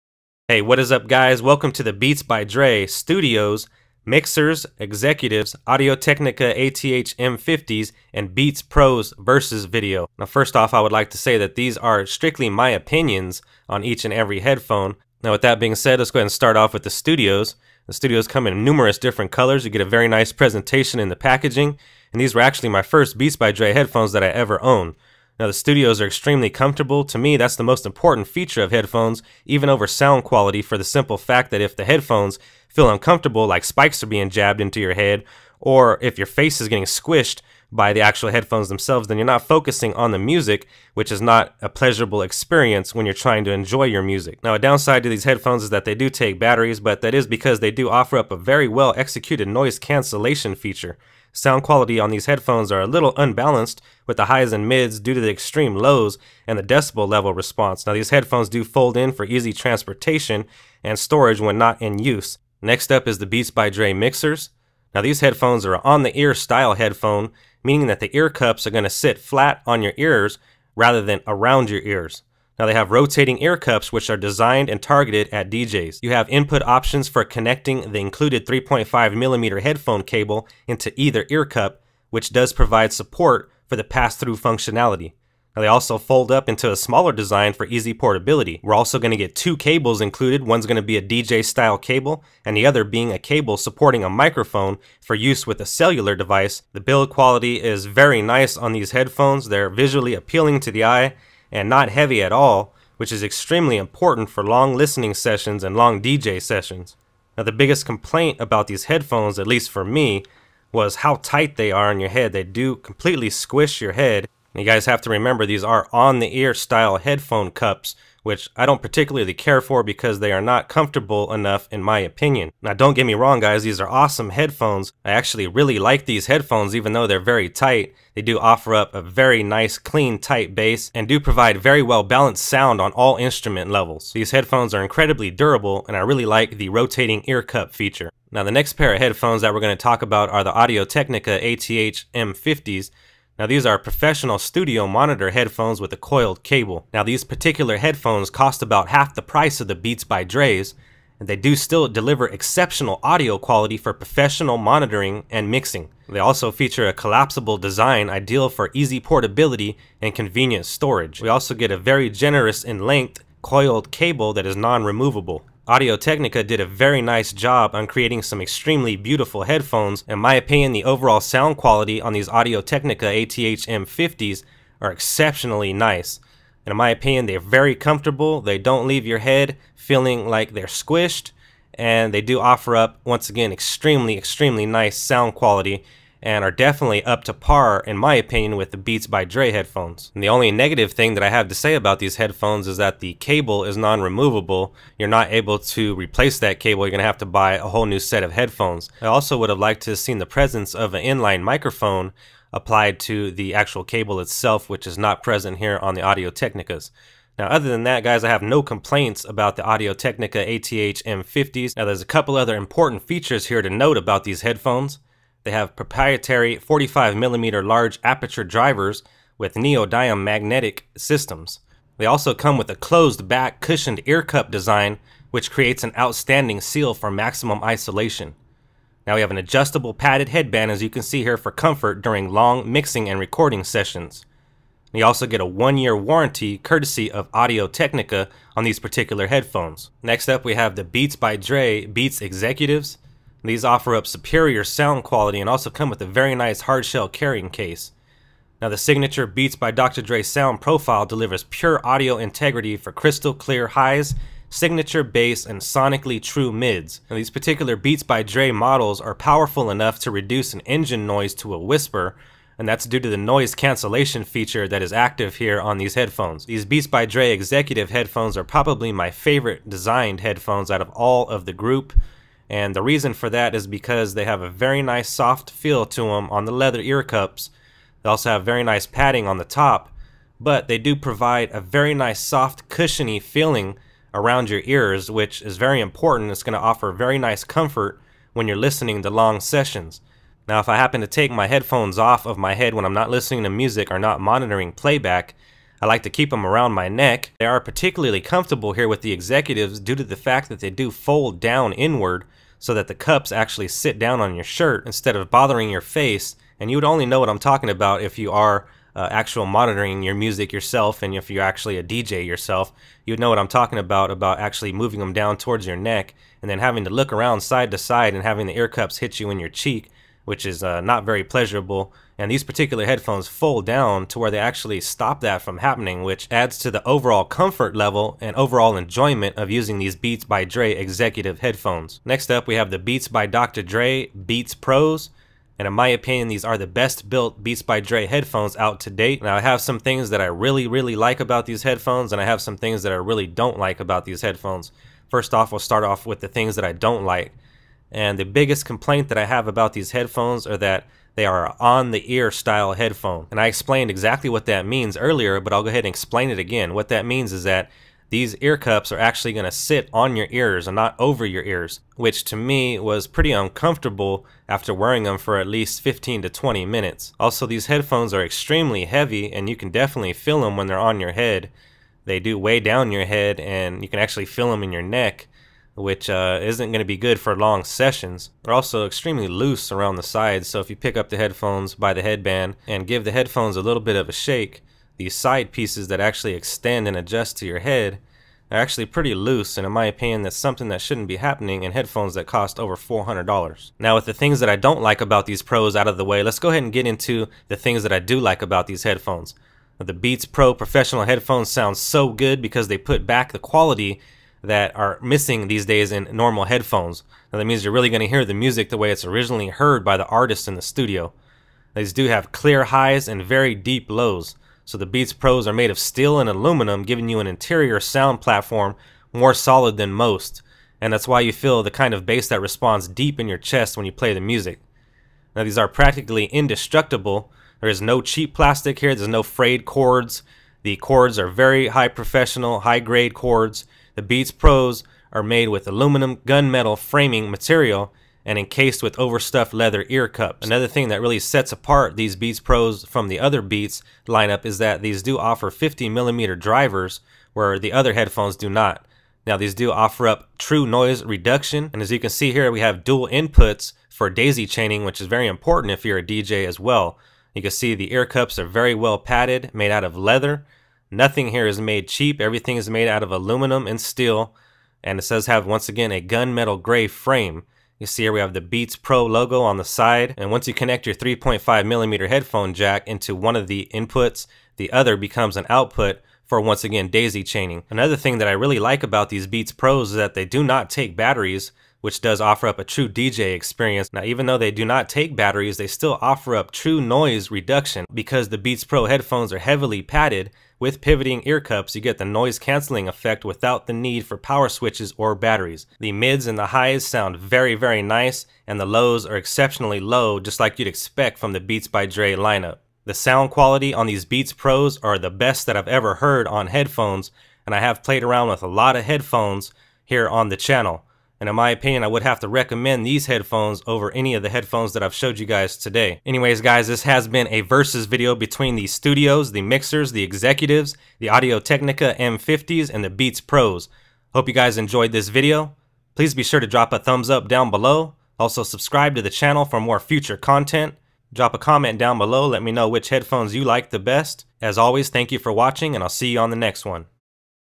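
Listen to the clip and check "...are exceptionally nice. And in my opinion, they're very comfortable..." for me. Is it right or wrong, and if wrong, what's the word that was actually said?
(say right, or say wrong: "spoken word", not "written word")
right.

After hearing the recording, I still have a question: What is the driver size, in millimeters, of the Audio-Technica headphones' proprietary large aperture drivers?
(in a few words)
45 millimeters.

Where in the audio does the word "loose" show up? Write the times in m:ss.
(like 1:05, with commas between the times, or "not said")
6:19, 6:29.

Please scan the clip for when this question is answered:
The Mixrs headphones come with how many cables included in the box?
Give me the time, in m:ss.
1:29.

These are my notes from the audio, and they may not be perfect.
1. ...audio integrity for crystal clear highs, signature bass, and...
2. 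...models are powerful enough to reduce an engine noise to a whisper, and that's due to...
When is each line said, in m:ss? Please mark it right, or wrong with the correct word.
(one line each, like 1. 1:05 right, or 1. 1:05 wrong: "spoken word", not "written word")
1. 4:11 right
2. 4:18 right.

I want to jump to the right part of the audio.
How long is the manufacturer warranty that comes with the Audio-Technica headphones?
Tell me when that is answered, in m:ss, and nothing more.
3:55.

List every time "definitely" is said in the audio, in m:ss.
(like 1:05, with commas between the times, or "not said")
3:06, 6:09.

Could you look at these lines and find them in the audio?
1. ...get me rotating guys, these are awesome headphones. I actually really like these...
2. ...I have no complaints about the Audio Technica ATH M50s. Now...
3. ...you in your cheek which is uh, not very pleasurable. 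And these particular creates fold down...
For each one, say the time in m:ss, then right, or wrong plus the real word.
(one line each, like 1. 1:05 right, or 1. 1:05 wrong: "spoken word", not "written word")
1. 2:02 wrong: "wrong", not "rotating"
2. 3:28 right
3. 5:19 wrong: "headphones", not "creates".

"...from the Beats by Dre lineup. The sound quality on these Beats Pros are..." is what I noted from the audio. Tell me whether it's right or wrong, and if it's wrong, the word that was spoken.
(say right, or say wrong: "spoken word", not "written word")
right.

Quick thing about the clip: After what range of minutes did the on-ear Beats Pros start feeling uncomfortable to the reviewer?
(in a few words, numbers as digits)
15 to 20 minutes.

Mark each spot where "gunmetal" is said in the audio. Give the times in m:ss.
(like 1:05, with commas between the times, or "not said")
7:16, 7:46.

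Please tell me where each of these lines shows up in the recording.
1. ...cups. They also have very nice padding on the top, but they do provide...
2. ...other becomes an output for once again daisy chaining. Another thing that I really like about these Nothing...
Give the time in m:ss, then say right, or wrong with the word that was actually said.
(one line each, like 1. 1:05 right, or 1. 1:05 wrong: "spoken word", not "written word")
1. 4:37 right
2. 7:54 wrong: "Beats", not "Nothing".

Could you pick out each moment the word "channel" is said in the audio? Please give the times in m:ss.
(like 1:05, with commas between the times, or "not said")
8:30, 8:49.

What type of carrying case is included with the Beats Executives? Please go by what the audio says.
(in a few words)
Hardshell carrying case.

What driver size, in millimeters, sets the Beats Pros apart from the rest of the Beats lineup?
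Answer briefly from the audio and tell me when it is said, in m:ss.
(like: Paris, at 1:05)
50 millimeters, at 7:25.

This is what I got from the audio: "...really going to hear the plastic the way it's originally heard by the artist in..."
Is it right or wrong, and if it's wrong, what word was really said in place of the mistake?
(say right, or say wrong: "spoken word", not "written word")
wrong: "music", not "plastic".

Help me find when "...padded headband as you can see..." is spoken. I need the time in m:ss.
3:49.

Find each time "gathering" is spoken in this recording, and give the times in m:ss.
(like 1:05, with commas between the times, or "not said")
not said.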